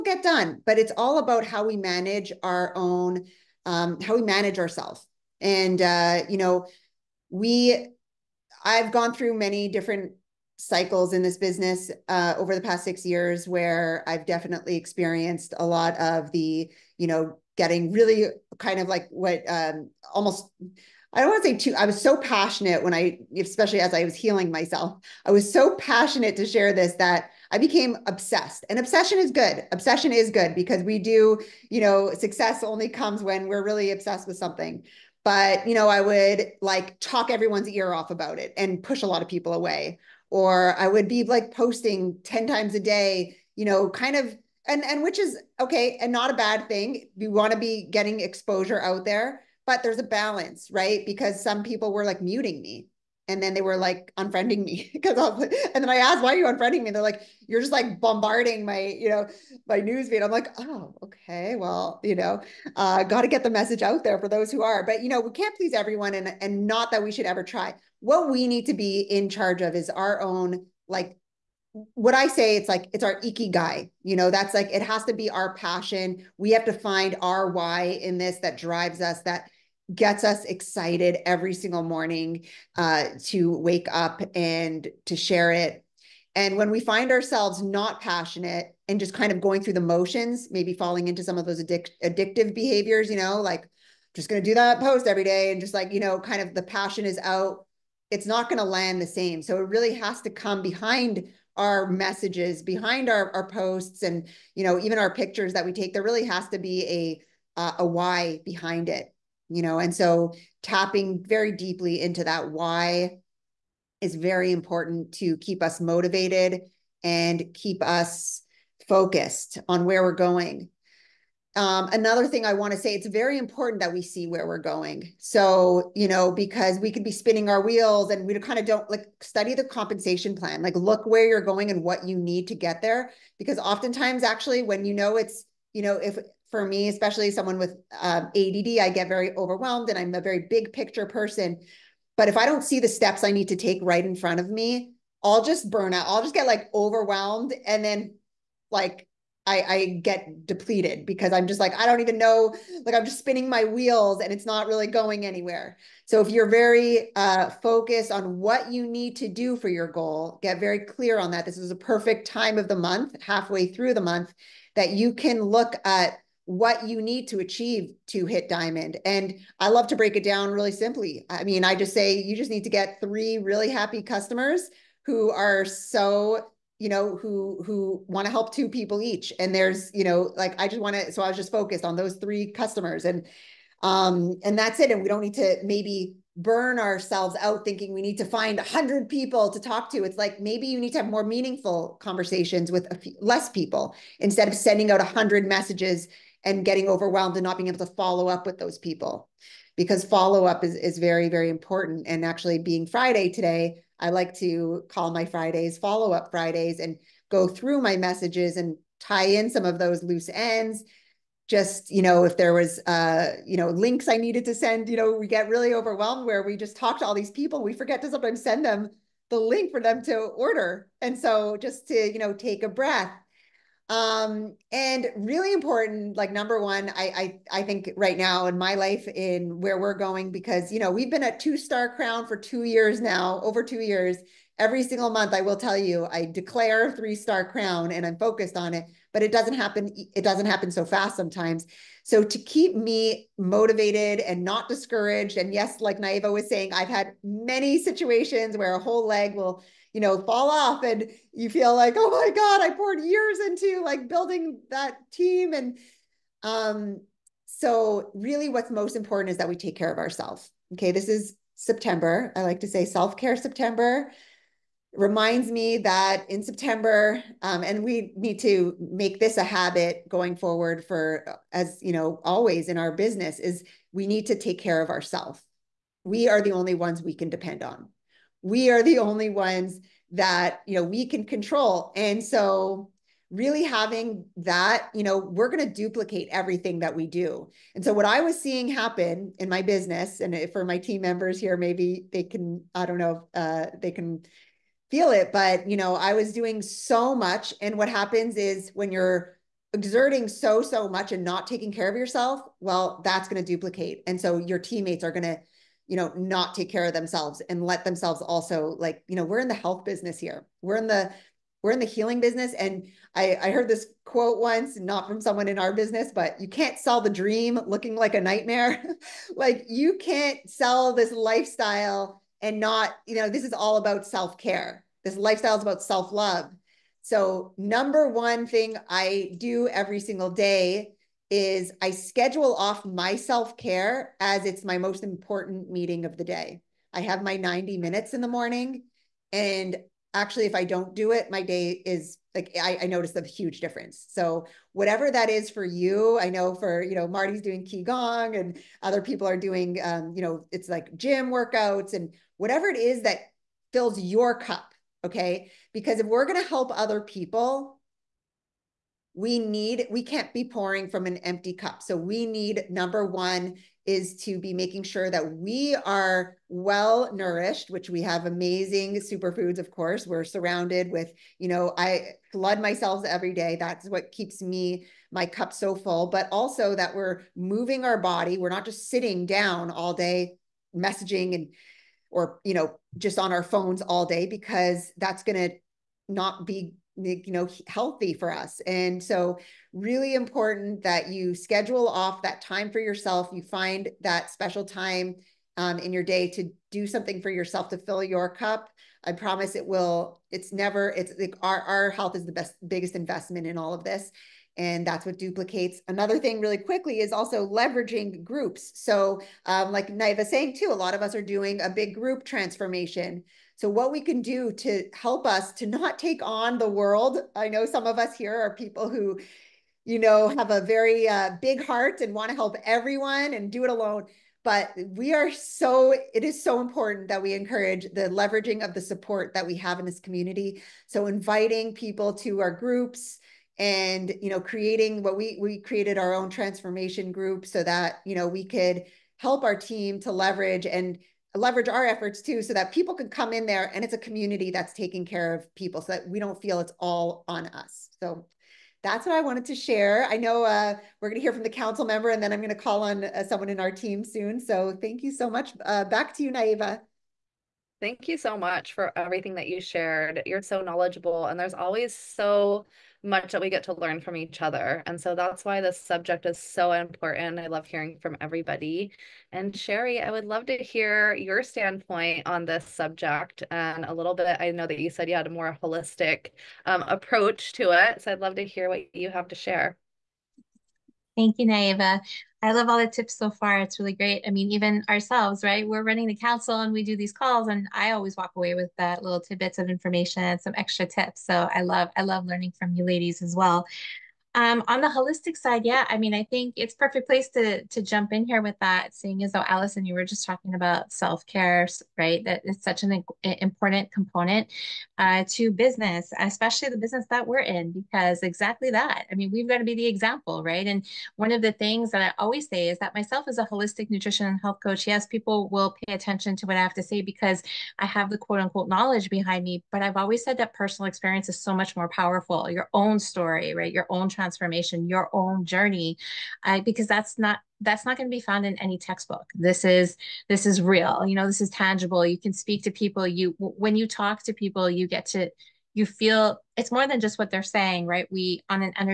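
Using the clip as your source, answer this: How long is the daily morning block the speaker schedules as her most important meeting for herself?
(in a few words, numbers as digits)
90 minutes.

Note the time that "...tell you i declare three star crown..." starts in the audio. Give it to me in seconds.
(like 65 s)
235 s.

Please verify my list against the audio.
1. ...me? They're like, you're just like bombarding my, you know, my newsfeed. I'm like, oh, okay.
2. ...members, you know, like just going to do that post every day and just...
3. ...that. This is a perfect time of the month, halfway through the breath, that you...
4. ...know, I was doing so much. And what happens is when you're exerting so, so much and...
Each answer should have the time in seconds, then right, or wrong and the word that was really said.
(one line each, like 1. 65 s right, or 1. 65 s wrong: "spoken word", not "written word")
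1. 56 s right
2. 92 s wrong: "behaviors", not "members"
3. 161 s wrong: "month", not "breath"
4. 295 s right.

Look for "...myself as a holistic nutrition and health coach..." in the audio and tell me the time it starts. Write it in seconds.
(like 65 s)
512 s.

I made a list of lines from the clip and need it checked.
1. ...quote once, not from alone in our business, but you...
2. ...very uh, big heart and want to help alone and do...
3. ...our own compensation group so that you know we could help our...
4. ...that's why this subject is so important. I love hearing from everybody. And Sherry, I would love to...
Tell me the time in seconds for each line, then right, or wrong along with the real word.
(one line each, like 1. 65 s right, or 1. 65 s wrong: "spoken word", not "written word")
1. 314 s wrong: "someone", not "alone"
2. 420 s wrong: "everyone", not "alone"
3. 435 s wrong: "transformation", not "compensation"
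4. 465 s right.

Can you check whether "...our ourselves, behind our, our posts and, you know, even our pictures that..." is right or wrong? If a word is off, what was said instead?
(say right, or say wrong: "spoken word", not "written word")
wrong: "messages", not "ourselves".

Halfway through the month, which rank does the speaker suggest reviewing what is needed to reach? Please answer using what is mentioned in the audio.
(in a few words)
diamond.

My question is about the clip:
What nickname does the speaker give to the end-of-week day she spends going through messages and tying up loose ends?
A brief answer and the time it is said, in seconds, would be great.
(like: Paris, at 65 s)
follow up Fridays, at 205 s.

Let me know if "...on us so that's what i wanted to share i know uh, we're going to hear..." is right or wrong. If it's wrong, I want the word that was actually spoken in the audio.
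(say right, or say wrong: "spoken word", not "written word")
right.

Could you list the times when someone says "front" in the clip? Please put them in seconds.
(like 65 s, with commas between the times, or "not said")
144 s.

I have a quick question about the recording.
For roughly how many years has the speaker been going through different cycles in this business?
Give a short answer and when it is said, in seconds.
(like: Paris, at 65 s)
6 years, at 12 s.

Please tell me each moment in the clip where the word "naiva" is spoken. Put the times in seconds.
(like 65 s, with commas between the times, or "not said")
245 s, 409 s, 456 s, 481 s.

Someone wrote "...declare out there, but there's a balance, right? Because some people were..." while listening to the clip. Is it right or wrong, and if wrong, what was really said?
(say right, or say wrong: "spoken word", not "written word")
wrong: "exposure", not "declare".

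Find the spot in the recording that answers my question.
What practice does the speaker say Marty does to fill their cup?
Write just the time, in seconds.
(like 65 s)
347 s.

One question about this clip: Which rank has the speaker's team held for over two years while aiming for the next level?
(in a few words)
two star crown.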